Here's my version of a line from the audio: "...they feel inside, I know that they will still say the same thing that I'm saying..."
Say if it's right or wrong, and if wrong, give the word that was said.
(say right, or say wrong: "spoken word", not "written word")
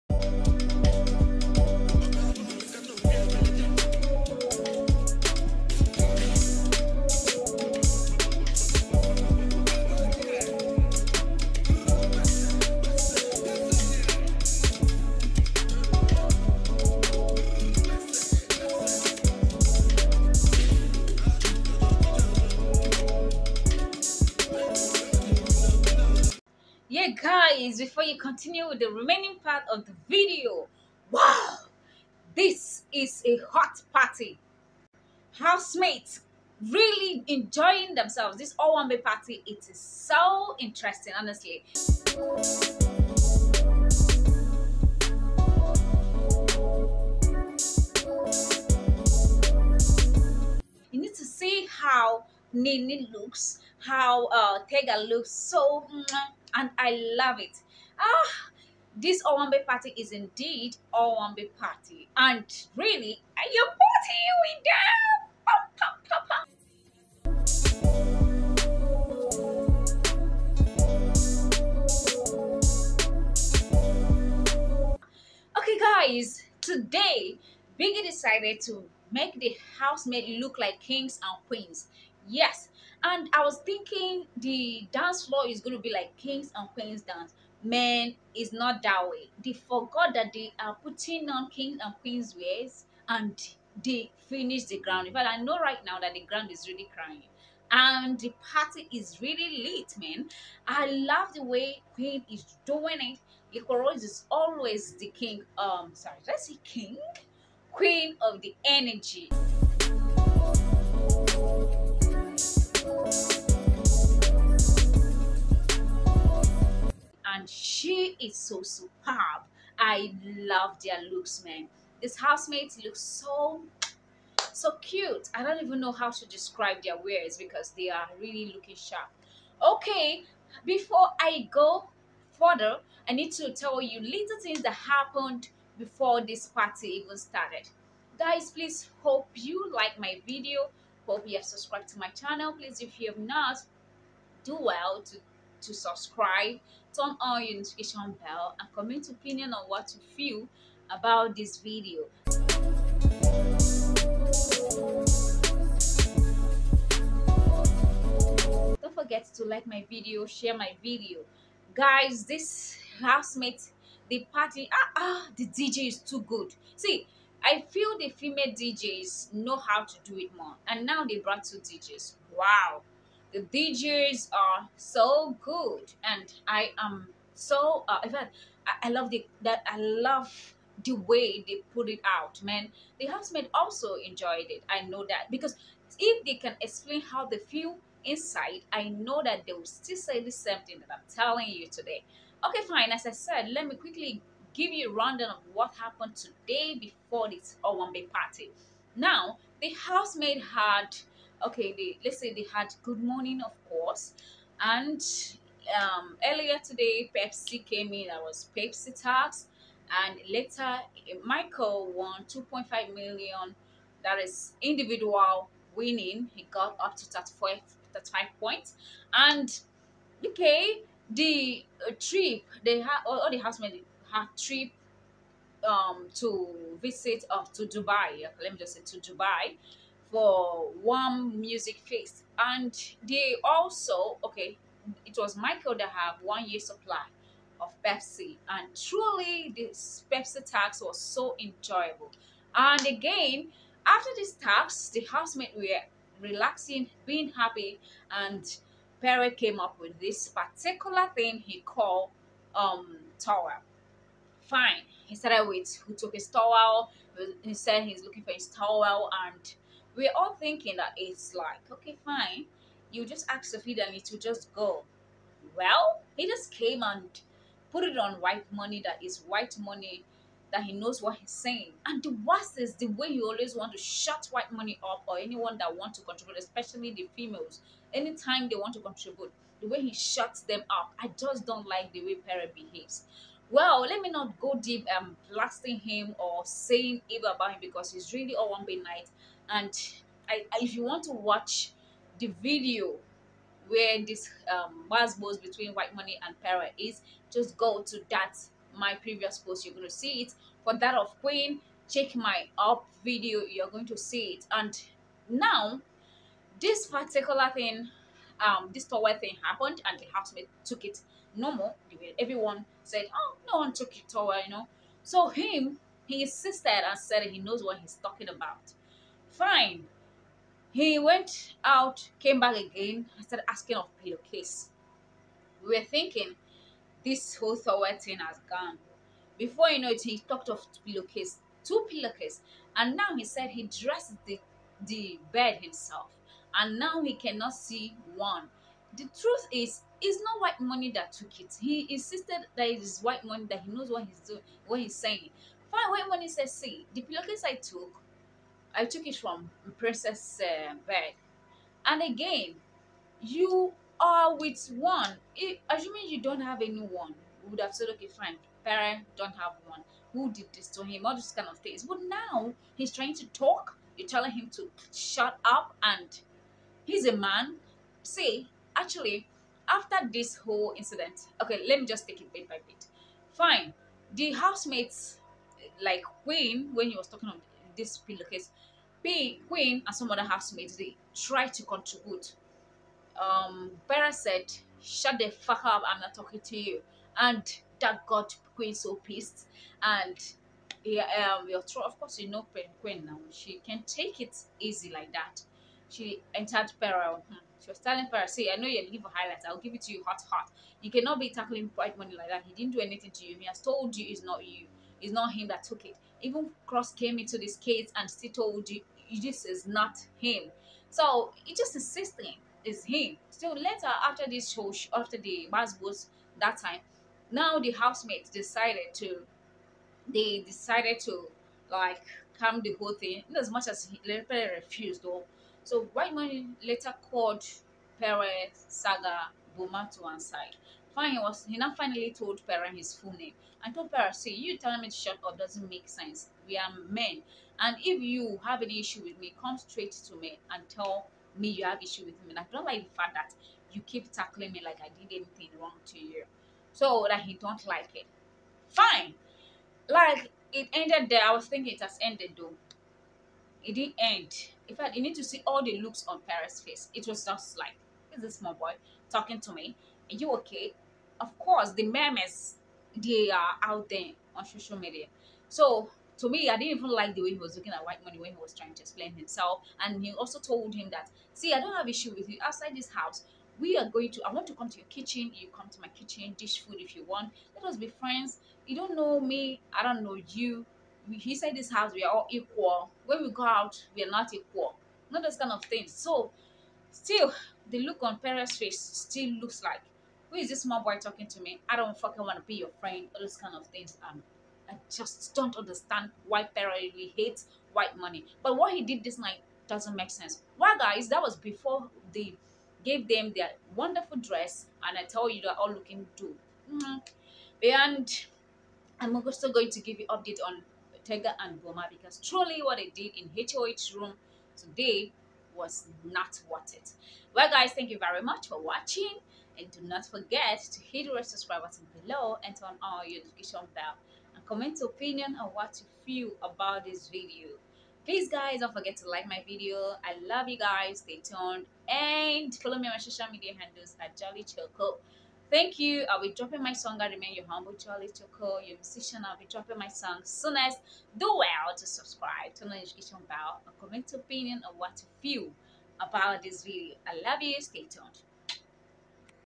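wrong: "telling", not "saying".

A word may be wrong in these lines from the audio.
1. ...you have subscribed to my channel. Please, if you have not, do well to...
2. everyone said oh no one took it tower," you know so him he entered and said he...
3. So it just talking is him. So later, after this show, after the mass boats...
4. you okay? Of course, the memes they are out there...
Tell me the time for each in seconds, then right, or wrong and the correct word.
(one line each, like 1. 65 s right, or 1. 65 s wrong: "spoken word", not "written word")
1. 141 s right
2. 312 s wrong: "insisted", not "entered"
3. 410 s wrong: "insisting", not "talking"
4. 460 s right.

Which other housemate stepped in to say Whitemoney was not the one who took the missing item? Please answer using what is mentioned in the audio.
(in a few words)
Cross.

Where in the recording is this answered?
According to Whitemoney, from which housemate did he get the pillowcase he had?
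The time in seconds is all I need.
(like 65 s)
349 s.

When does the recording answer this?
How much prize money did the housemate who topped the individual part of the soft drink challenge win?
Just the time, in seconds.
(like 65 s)
212 s.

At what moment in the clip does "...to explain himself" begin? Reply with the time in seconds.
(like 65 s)
468 s.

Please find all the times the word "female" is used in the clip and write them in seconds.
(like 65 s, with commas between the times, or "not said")
168 s, 277 s.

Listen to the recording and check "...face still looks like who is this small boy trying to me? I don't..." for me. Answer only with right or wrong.
wrong.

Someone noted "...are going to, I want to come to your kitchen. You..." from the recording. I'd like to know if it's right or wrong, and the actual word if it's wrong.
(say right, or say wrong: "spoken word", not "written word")
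right.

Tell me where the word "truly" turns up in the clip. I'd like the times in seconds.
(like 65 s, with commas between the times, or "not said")
238 s, 512 s.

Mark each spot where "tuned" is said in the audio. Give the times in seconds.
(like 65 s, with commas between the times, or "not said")
531 s, 547 s.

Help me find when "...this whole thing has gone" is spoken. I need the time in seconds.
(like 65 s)
327 s.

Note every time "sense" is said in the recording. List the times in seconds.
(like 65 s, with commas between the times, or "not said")
435 s, 500 s.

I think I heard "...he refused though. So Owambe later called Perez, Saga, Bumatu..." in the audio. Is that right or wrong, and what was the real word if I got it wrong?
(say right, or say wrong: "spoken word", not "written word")
wrong: "Whitemoney", not "Owambe".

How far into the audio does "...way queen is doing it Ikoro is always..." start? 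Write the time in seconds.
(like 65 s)
101 s.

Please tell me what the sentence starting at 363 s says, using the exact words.
You're telling him to shut up, and he's a man.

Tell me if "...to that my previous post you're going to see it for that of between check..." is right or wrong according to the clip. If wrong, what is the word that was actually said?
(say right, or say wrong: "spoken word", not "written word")
wrong: "queen", not "between".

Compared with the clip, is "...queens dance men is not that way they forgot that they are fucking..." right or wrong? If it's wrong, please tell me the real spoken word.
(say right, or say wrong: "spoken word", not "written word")
wrong: "putting", not "fucking".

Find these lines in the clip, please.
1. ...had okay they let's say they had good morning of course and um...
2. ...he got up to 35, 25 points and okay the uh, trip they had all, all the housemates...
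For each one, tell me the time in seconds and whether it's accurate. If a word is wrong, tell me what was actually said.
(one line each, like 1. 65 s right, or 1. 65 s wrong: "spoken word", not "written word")
1. 200 s right
2. 216 s wrong: "35", not "25".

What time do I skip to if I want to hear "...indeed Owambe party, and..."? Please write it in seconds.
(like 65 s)
60 s.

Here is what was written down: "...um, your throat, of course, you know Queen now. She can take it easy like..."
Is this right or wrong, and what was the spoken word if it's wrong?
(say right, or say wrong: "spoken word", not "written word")
right.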